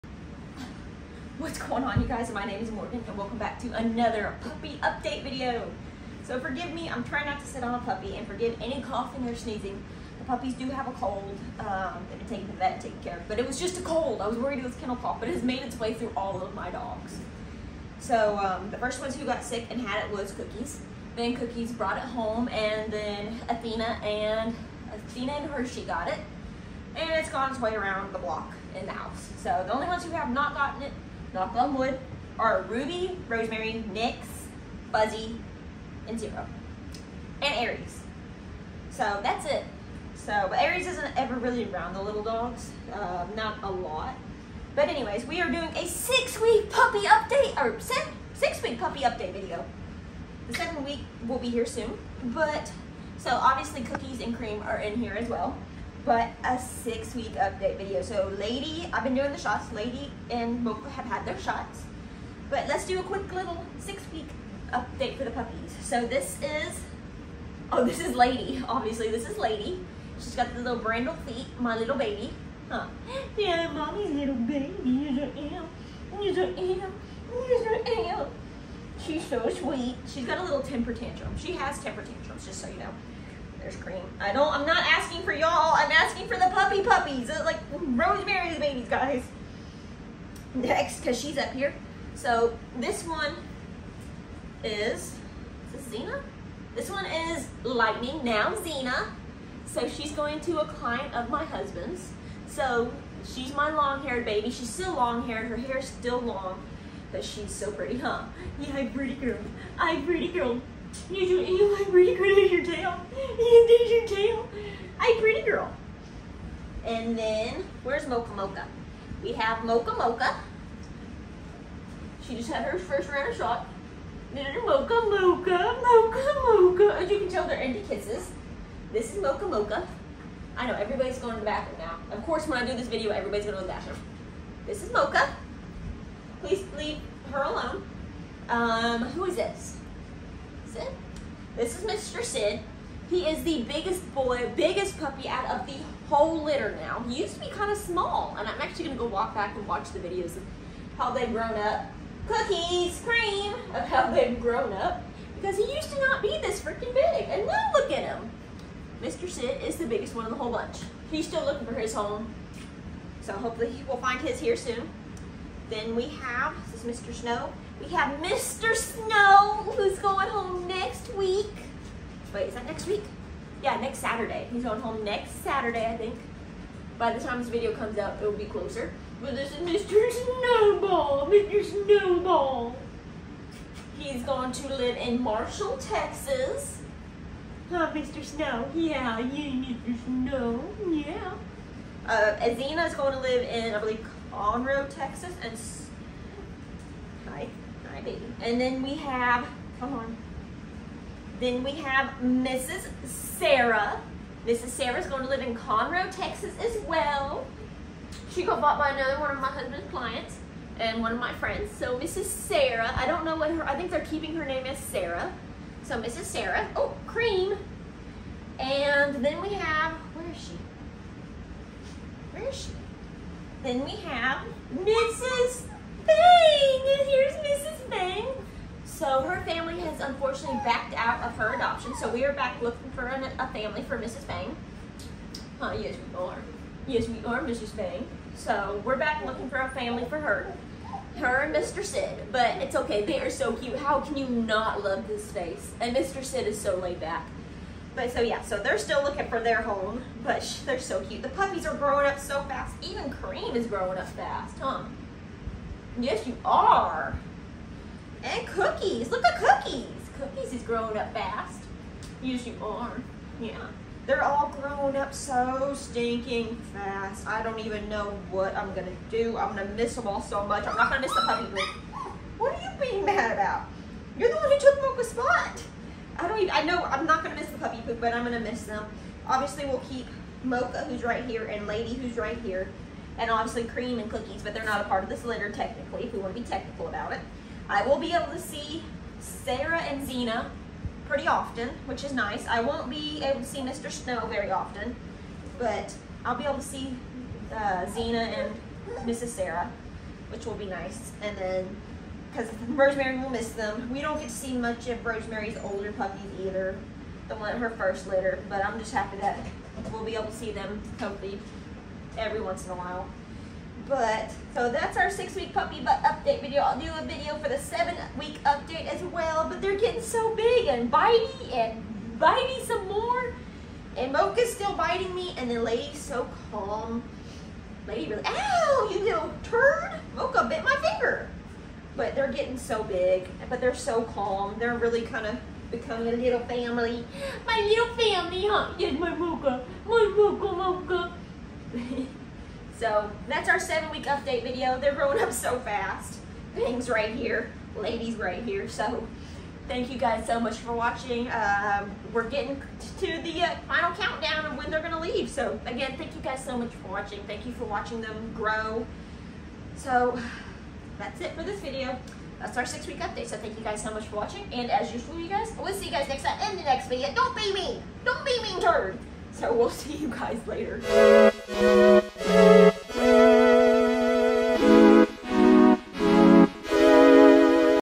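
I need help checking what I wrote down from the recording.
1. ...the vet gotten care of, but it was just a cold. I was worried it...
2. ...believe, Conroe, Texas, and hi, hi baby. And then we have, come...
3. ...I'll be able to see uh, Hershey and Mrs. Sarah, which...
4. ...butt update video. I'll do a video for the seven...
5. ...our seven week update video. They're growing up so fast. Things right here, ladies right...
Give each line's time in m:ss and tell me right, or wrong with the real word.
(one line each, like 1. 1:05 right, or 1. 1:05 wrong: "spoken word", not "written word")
1. 0:12 wrong: "taken", not "gotten"
2. 3:13 right
3. 4:56 wrong: "Xena", not "Hershey"
4. 5:15 right
5. 5:43 right.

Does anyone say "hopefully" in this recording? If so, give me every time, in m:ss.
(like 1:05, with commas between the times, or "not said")
2:43, 5:10.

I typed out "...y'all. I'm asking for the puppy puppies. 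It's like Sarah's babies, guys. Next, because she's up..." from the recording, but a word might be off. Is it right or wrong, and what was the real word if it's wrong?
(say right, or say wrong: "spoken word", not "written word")
wrong: "Rosemary", not "Sarah".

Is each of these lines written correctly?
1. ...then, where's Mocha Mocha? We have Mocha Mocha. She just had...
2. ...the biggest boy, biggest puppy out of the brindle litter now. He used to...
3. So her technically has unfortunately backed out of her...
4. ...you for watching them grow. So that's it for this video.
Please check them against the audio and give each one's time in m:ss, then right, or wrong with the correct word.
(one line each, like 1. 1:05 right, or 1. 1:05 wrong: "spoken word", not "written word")
1. 1:57 right
2. 2:23 wrong: "whole", not "brindle"
3. 3:48 wrong: "family", not "technically"
4. 5:57 right.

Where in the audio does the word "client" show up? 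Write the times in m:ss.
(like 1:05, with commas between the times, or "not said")
1:40, 3:29.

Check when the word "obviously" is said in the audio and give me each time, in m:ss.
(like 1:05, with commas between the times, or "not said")
0:53, 1:08, 4:39, 4:43.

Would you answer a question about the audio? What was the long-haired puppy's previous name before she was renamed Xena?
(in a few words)
Lightning.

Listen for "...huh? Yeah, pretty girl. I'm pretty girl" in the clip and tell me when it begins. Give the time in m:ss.
1:47.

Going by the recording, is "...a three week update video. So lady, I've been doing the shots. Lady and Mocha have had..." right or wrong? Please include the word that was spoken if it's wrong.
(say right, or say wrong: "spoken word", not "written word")
wrong: "six", not "three".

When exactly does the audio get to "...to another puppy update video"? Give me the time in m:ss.
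0:03.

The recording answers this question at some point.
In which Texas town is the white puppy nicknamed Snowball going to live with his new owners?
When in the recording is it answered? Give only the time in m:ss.
3:05.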